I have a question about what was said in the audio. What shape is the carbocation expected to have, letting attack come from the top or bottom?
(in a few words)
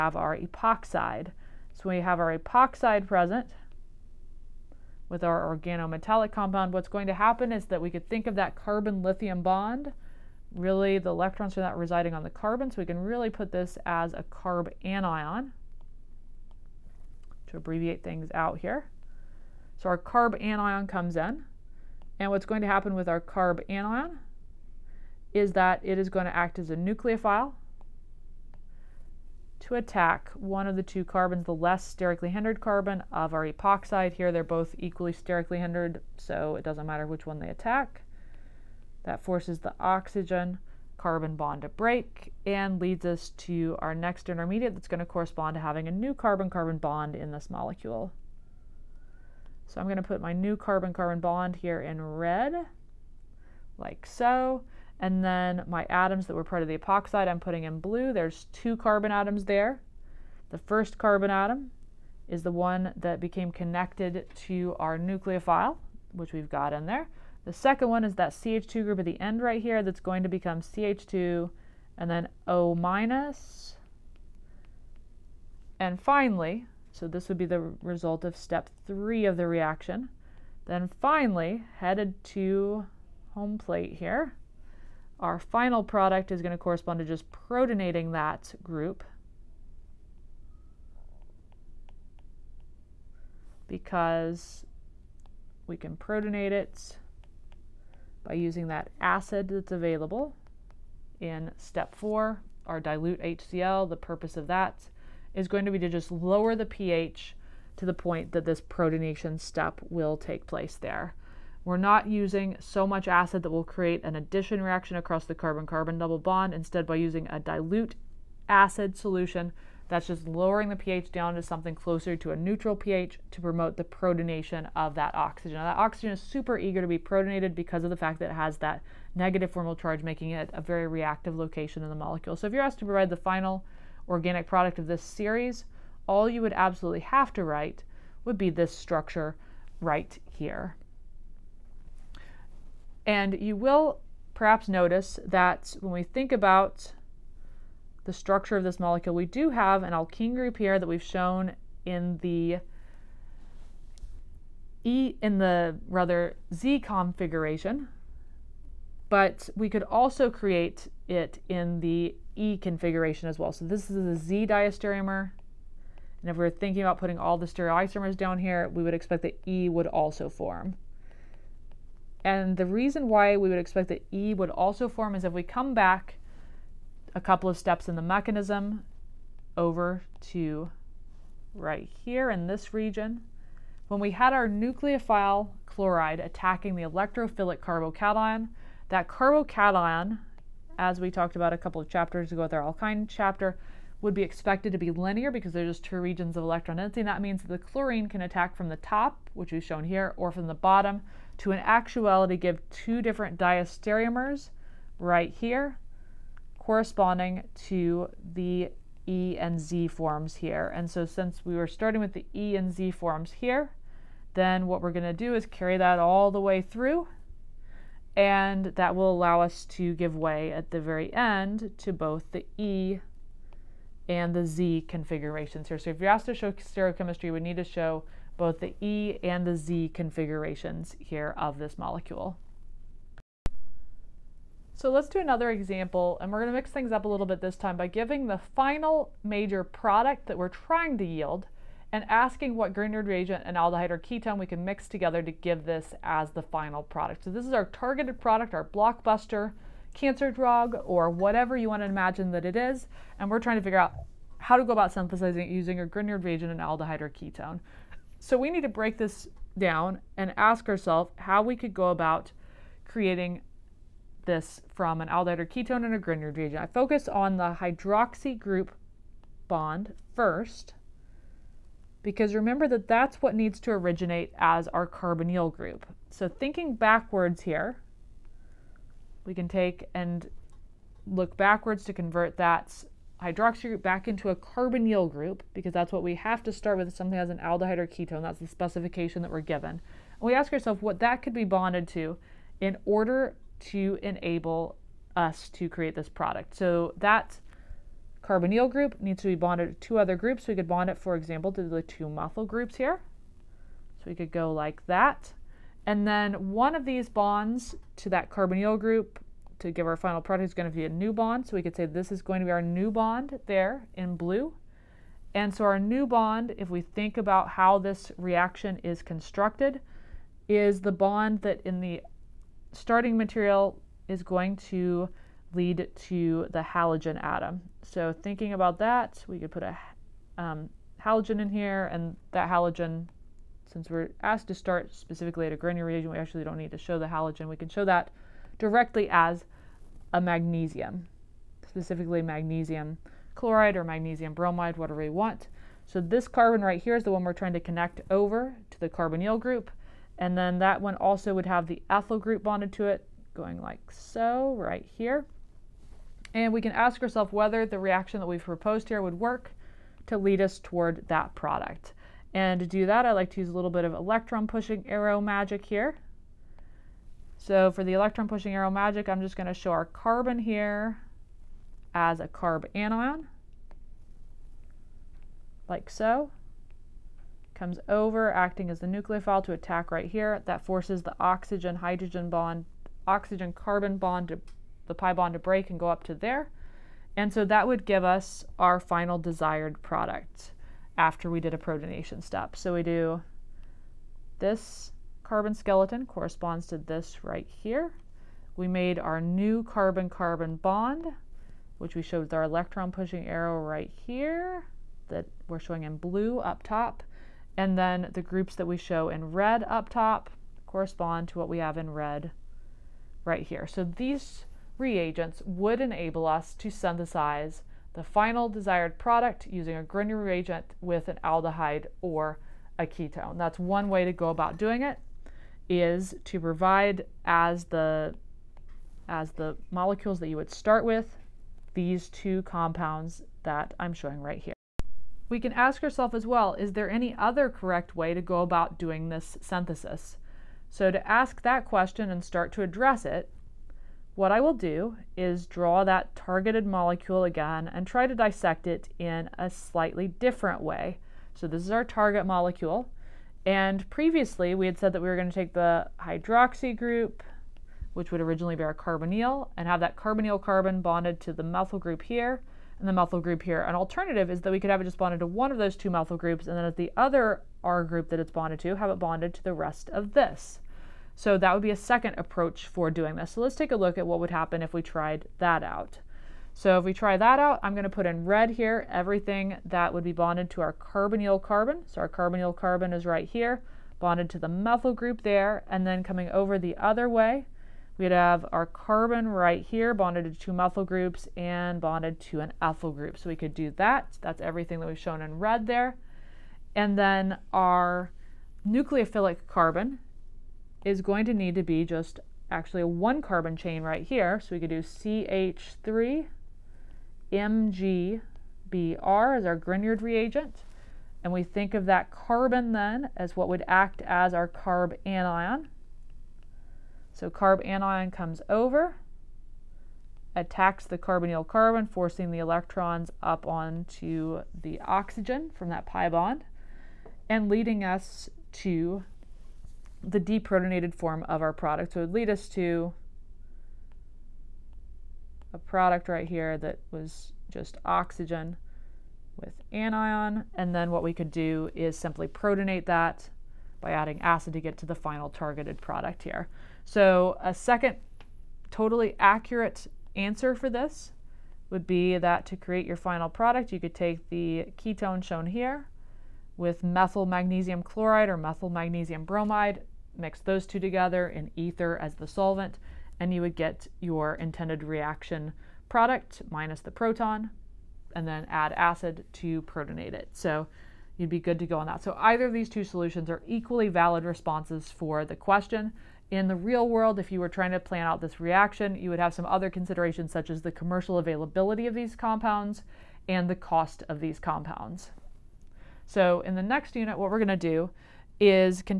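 linear.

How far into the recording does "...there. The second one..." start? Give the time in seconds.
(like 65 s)
66 s.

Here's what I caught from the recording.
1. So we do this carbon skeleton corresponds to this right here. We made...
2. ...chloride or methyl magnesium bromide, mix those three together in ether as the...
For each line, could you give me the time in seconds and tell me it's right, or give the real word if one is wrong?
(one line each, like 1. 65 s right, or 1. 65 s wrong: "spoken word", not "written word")
1. 392 s right
2. 557 s wrong: "two", not "three".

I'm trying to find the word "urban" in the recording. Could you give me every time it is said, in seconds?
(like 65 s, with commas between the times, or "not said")
not said.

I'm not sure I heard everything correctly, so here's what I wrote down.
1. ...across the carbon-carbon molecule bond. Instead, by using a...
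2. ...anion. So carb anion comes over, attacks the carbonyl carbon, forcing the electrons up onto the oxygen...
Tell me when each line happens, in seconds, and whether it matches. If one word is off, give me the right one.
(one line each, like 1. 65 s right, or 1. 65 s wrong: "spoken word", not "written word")
1. 114 s wrong: "double", not "molecule"
2. 515 s right.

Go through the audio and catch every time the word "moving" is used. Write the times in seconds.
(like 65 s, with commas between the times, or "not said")
not said.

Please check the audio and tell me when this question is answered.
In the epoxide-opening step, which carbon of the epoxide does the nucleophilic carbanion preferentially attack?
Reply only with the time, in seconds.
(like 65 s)
31 s.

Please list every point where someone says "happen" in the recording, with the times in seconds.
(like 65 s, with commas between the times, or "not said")
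7 s, 22 s, 474 s.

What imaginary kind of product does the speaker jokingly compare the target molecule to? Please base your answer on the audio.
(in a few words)
blockbuster cancer drug.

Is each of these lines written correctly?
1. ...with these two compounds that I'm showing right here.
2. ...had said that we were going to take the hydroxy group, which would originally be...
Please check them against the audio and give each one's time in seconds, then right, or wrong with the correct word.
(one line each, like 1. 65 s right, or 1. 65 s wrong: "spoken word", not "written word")
1. 430 s right
2. 454 s right.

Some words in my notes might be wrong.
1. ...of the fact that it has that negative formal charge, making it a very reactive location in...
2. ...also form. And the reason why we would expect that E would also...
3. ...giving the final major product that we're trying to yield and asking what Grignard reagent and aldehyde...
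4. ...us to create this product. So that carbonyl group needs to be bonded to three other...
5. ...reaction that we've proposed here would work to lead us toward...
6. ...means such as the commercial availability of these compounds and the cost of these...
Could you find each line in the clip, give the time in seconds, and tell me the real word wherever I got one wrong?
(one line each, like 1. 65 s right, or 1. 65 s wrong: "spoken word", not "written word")
1. 127 s right
2. 169 s right
3. 237 s right
4. 295 s wrong: "two", not "three"
5. 357 s right
6. 579 s wrong: "considerations", not "means".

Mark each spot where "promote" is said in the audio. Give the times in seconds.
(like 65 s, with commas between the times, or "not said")
123 s.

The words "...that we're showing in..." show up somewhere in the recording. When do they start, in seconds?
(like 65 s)
405 s.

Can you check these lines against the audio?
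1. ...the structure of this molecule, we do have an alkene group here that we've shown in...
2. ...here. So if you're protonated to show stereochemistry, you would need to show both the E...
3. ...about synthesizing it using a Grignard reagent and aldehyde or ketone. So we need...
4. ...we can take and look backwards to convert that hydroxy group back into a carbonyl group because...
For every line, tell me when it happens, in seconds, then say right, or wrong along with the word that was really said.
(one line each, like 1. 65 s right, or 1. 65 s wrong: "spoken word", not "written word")
1. 148 s right
2. 225 s wrong: "asked", not "protonated"
3. 254 s right
4. 279 s right.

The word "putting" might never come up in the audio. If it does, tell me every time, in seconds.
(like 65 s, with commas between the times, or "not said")
57 s, 166 s.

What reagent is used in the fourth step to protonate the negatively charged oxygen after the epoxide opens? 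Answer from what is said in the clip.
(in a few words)
dilute HCl.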